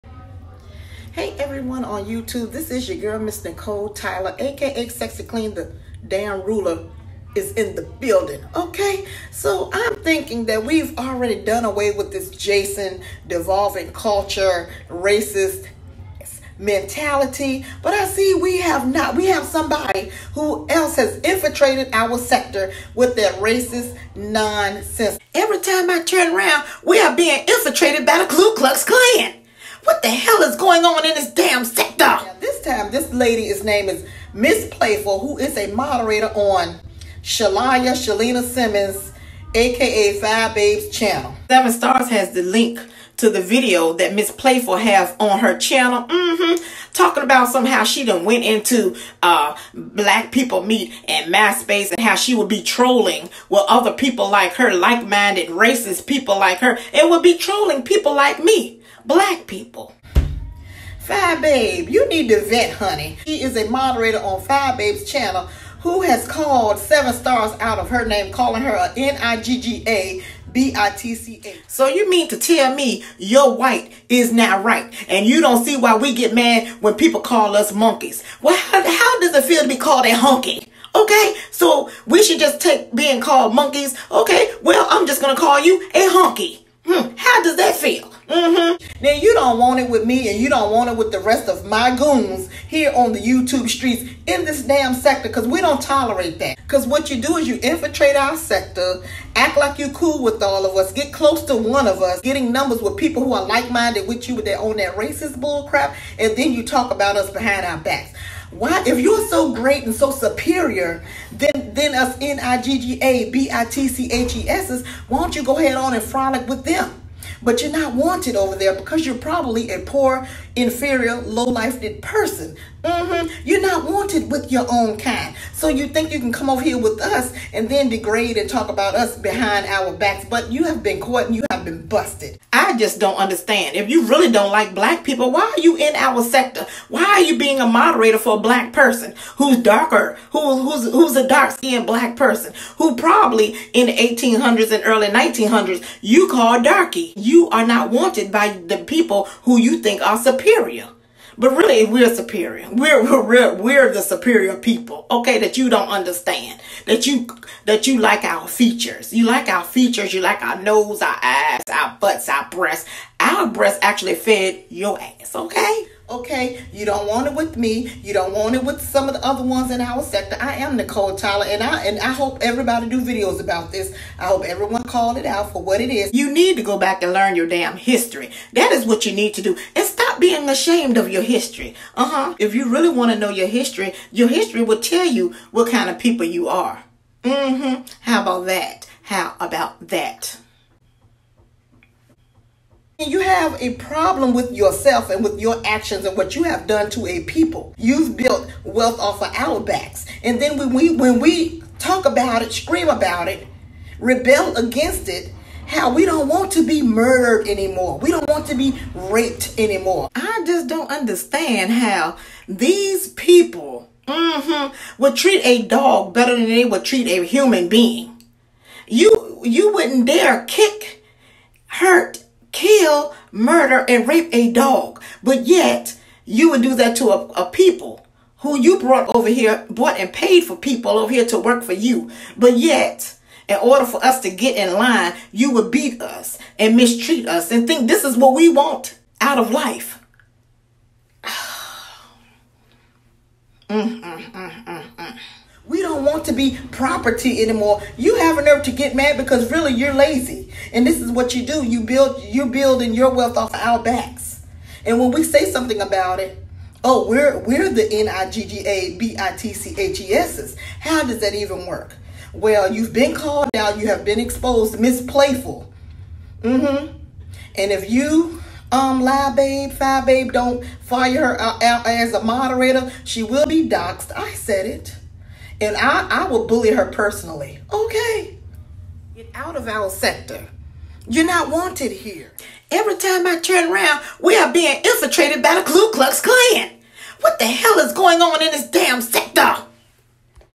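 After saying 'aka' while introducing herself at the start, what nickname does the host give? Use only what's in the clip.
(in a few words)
Sexy Clean.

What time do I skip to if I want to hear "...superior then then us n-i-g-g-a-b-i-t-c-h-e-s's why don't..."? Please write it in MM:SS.
01:50.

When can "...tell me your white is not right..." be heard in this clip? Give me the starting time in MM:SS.
01:12.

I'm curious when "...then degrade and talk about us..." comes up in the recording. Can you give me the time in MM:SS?
02:07.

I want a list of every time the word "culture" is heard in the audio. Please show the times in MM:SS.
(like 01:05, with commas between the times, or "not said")
00:13.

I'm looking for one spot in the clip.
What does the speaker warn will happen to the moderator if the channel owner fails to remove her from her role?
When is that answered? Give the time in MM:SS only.
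04:33.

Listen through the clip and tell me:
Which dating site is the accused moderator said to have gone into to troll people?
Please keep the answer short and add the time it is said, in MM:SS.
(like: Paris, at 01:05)
Black People Meet, at 00:49.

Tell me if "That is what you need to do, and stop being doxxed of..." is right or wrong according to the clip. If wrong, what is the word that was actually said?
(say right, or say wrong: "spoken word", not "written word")
wrong: "ashamed", not "doxxed".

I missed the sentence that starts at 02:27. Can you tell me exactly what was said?
You are not wanted by the people who you think are superior.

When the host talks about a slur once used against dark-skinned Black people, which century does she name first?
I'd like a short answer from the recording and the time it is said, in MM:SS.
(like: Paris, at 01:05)
1800s, at 02:23.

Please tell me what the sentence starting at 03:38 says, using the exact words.
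You you wouldn't dare kick, hurt, kill, murder, and rape a dog.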